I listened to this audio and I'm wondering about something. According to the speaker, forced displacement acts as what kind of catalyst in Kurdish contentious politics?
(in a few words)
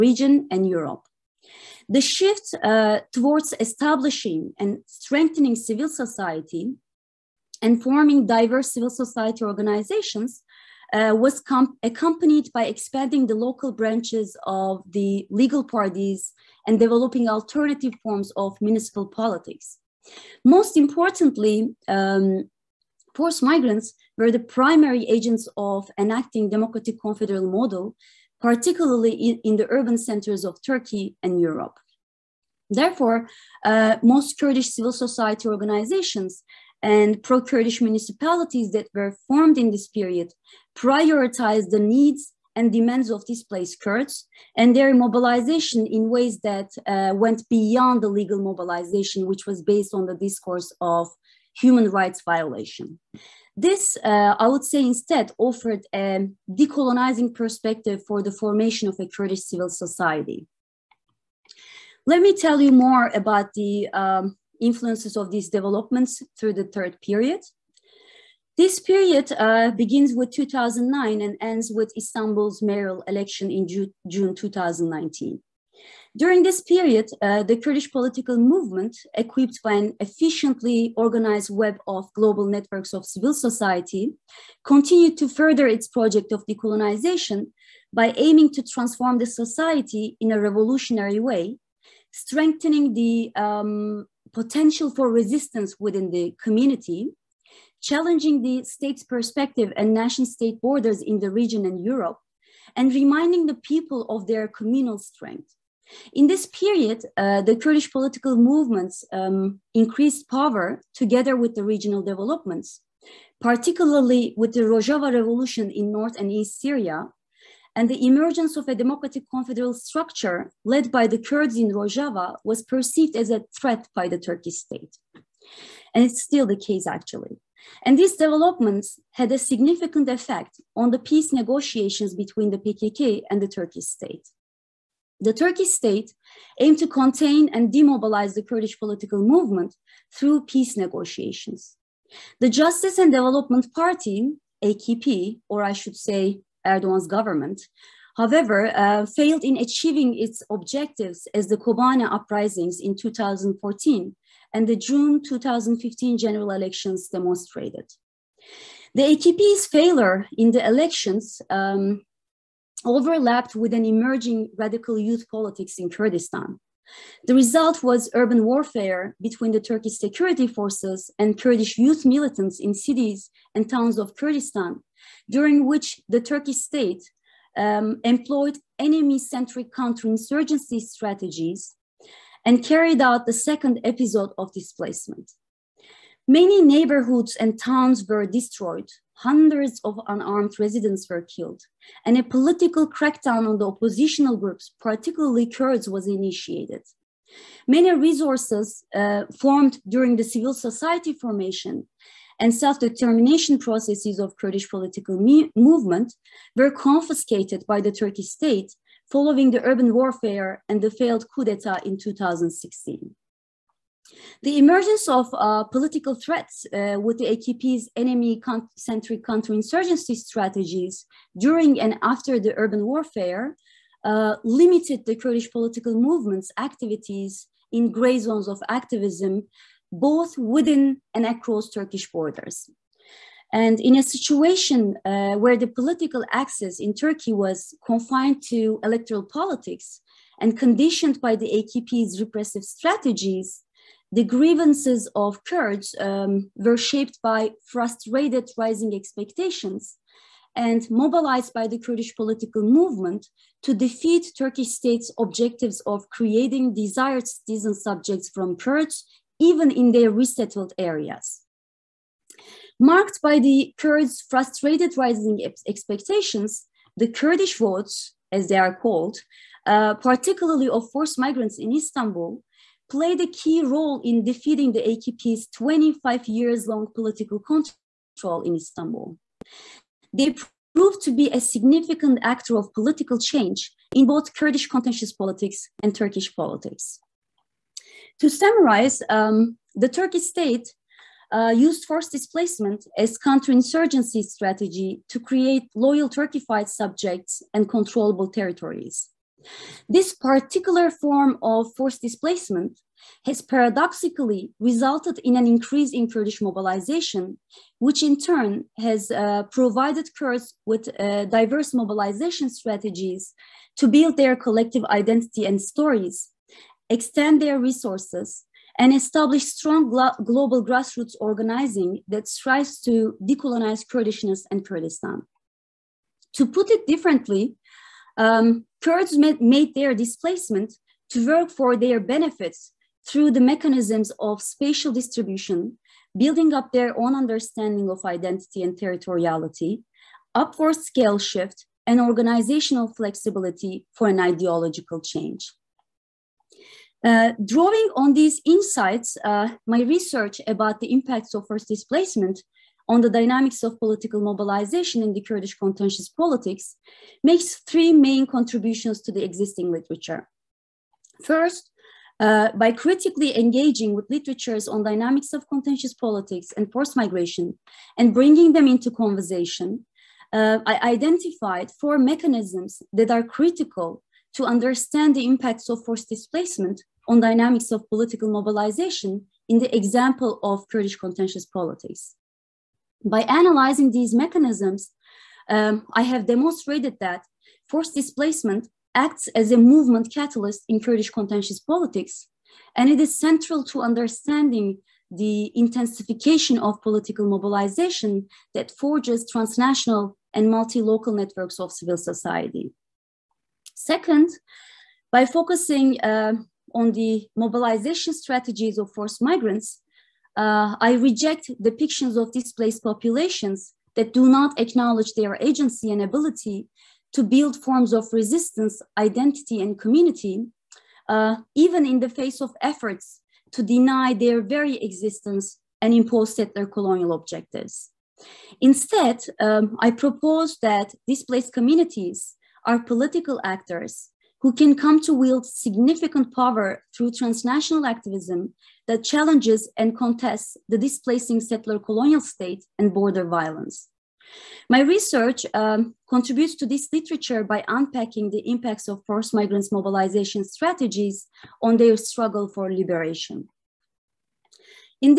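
movement catalyst.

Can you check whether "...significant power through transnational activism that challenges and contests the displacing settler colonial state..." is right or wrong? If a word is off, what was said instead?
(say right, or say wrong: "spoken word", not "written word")
right.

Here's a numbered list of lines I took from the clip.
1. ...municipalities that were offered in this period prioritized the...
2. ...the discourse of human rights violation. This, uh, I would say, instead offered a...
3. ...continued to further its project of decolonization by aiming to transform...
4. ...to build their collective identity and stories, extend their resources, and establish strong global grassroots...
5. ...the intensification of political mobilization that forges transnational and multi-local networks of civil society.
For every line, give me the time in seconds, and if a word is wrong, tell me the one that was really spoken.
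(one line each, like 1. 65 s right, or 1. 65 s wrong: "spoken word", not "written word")
1. 37 s wrong: "formed", not "offered"
2. 50 s right
3. 84 s right
4. 313 s right
5. 395 s right.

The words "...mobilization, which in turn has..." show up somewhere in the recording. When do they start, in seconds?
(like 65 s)
306 s.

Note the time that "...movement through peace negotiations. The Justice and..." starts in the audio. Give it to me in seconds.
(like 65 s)
139 s.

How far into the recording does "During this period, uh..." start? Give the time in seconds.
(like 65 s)
76 s.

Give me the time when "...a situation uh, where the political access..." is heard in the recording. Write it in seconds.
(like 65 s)
233 s.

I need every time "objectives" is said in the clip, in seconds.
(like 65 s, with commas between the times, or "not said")
150 s, 255 s, 427 s.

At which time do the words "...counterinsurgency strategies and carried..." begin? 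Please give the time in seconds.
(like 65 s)
179 s.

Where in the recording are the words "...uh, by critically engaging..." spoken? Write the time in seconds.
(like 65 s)
362 s.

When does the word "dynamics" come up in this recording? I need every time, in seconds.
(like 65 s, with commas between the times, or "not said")
353 s, 364 s, 377 s.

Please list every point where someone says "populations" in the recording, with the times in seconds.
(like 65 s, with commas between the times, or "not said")
412 s.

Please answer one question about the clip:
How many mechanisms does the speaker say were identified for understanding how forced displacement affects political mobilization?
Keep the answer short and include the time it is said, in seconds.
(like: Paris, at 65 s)
4, at 371 s.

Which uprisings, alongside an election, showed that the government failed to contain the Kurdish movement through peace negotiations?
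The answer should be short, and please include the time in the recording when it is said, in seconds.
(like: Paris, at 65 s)
Kobane uprisings, at 151 s.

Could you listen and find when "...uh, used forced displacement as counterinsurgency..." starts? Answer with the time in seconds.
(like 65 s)
291 s.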